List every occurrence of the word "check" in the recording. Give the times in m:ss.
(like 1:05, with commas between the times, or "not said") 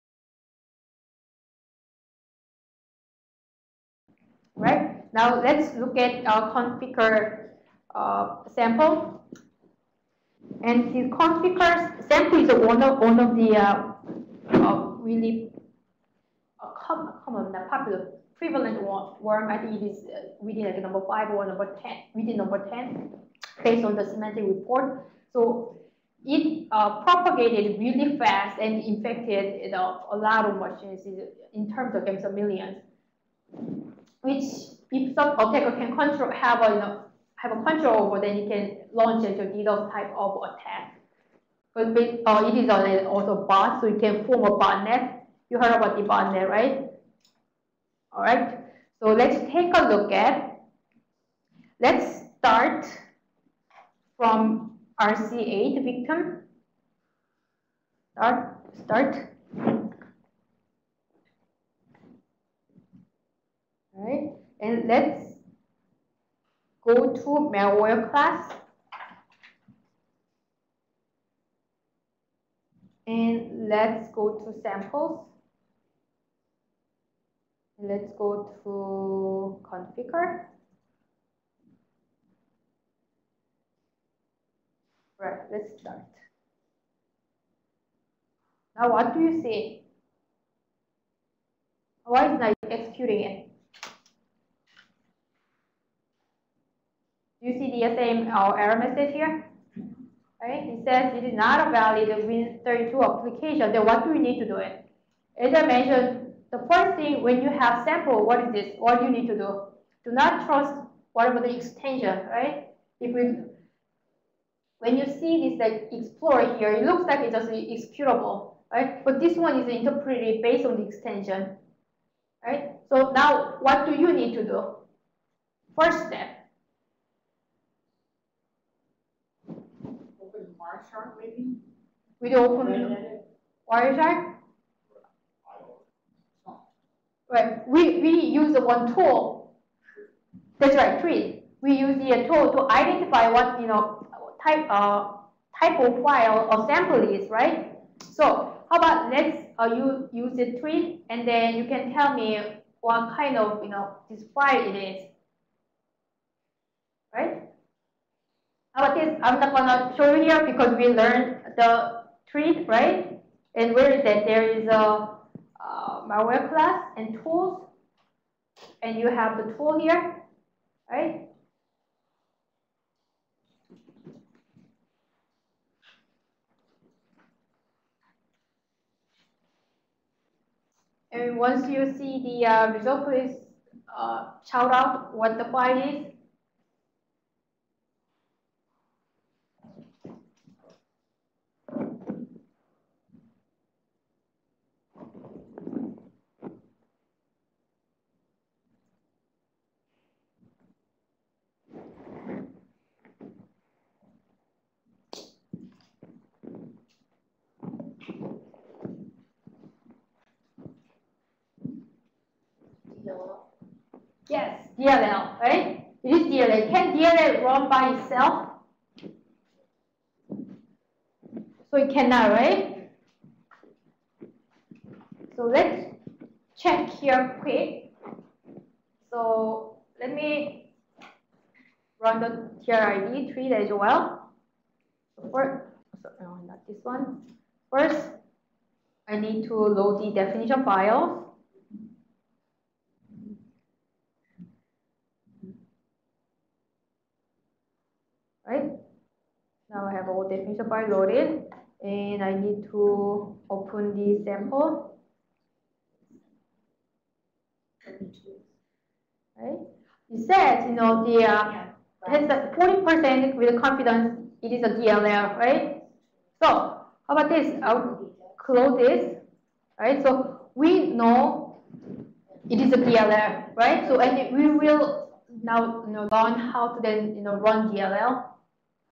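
3:46.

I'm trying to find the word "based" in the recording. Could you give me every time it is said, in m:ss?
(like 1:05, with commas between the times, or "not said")
0:23, 2:00.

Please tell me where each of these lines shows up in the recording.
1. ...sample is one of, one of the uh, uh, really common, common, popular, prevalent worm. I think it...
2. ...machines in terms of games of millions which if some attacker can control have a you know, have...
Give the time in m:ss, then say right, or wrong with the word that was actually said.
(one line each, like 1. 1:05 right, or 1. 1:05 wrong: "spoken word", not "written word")
1. 0:12 right
2. 0:30 right.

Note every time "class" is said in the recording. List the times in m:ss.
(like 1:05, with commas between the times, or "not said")
1:08, 2:46.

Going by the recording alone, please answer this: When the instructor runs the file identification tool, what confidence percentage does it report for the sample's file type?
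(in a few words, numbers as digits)
40%.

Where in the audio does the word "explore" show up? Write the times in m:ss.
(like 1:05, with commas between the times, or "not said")
1:55.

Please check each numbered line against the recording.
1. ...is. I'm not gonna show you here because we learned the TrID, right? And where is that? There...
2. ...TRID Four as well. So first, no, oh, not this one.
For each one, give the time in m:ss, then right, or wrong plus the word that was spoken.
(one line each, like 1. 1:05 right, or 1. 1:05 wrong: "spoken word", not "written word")
1. 2:34 right
2. 3:52 wrong: "Three", not "Four".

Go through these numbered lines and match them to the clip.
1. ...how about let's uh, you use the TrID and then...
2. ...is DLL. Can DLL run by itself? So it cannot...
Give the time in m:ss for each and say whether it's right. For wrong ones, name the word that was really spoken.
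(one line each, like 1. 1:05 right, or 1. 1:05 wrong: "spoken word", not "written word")
1. 2:28 right
2. 3:36 right.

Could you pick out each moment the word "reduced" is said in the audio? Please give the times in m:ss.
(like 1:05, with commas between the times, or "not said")
not said.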